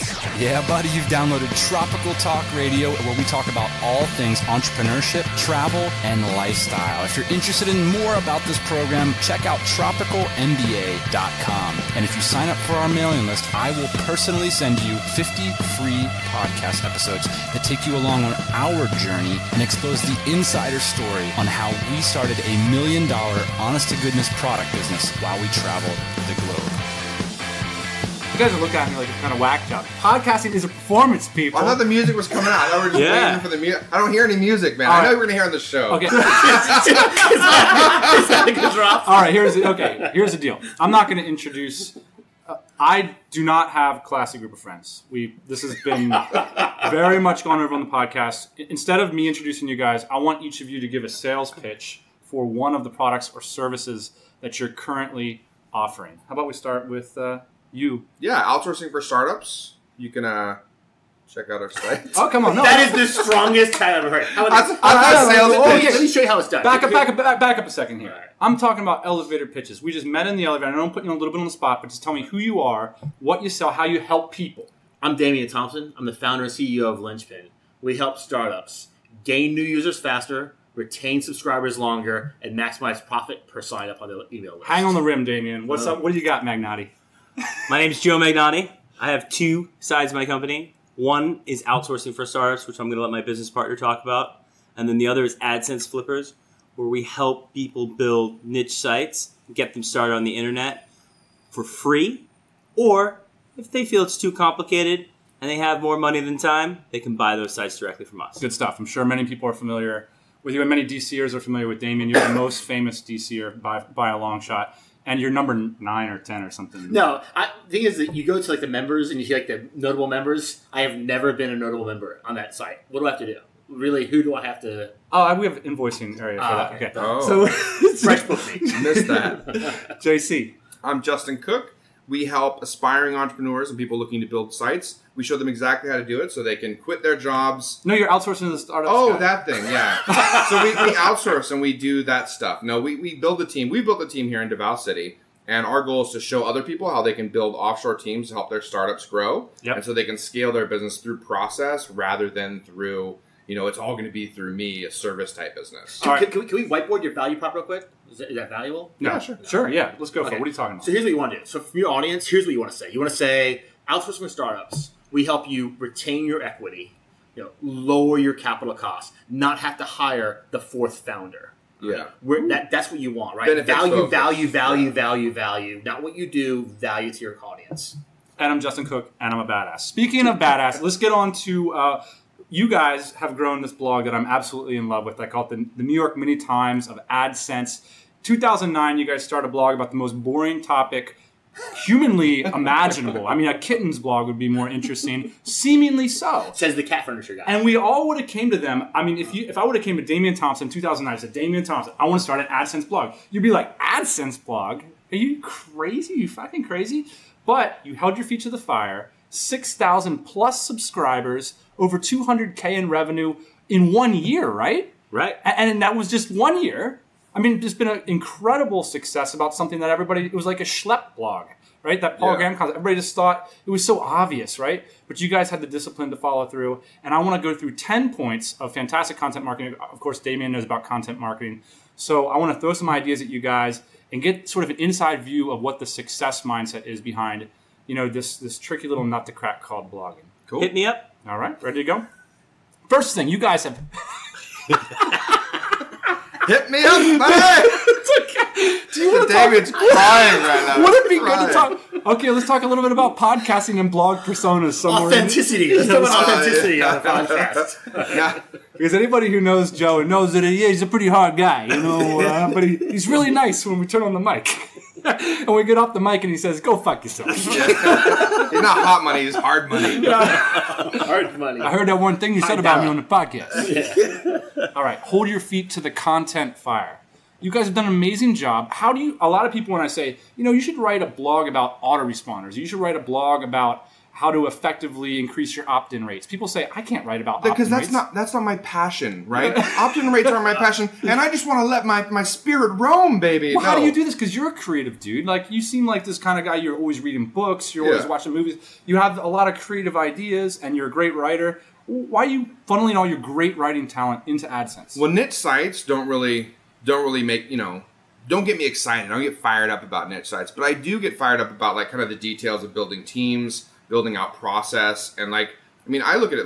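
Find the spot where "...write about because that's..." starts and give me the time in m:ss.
4:47.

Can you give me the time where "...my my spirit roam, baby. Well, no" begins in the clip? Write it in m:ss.
4:51.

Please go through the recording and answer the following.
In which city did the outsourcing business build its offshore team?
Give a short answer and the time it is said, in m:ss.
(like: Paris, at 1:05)
Davao City, at 2:24.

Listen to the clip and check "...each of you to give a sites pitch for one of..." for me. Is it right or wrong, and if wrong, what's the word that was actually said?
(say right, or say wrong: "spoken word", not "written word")
wrong: "sales", not "sites".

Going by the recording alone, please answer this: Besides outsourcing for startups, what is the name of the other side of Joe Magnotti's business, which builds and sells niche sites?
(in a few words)
AdSense Flippers.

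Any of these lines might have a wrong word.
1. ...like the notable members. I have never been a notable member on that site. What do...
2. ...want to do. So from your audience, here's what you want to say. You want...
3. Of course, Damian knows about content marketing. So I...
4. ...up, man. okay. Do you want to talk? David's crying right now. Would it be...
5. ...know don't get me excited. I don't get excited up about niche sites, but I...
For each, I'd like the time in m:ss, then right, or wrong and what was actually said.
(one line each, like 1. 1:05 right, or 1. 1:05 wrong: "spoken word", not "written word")
1. 1:59 right
2. 2:41 right
3. 3:49 right
4. 4:06 right
5. 5:07 wrong: "fired", not "excited".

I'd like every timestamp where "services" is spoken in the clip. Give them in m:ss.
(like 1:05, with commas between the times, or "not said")
0:53, 2:34.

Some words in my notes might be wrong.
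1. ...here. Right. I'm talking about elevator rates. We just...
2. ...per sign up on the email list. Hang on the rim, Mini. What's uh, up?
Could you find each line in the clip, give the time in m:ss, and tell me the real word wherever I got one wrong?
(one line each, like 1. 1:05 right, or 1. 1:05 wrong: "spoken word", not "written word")
1. 1:07 wrong: "pitches", not "rates"
2. 1:23 wrong: "Damian", not "Mini".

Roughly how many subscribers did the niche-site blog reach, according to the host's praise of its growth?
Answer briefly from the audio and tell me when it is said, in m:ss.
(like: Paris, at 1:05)
6,000, at 3:29.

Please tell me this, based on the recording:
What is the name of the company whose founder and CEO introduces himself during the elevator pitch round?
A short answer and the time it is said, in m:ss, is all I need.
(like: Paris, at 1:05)
Linchpin, at 1:16.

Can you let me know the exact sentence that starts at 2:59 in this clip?
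Speaking of badass, let's get on to uh, you guys have grown this blog that I'm absolutely in love with.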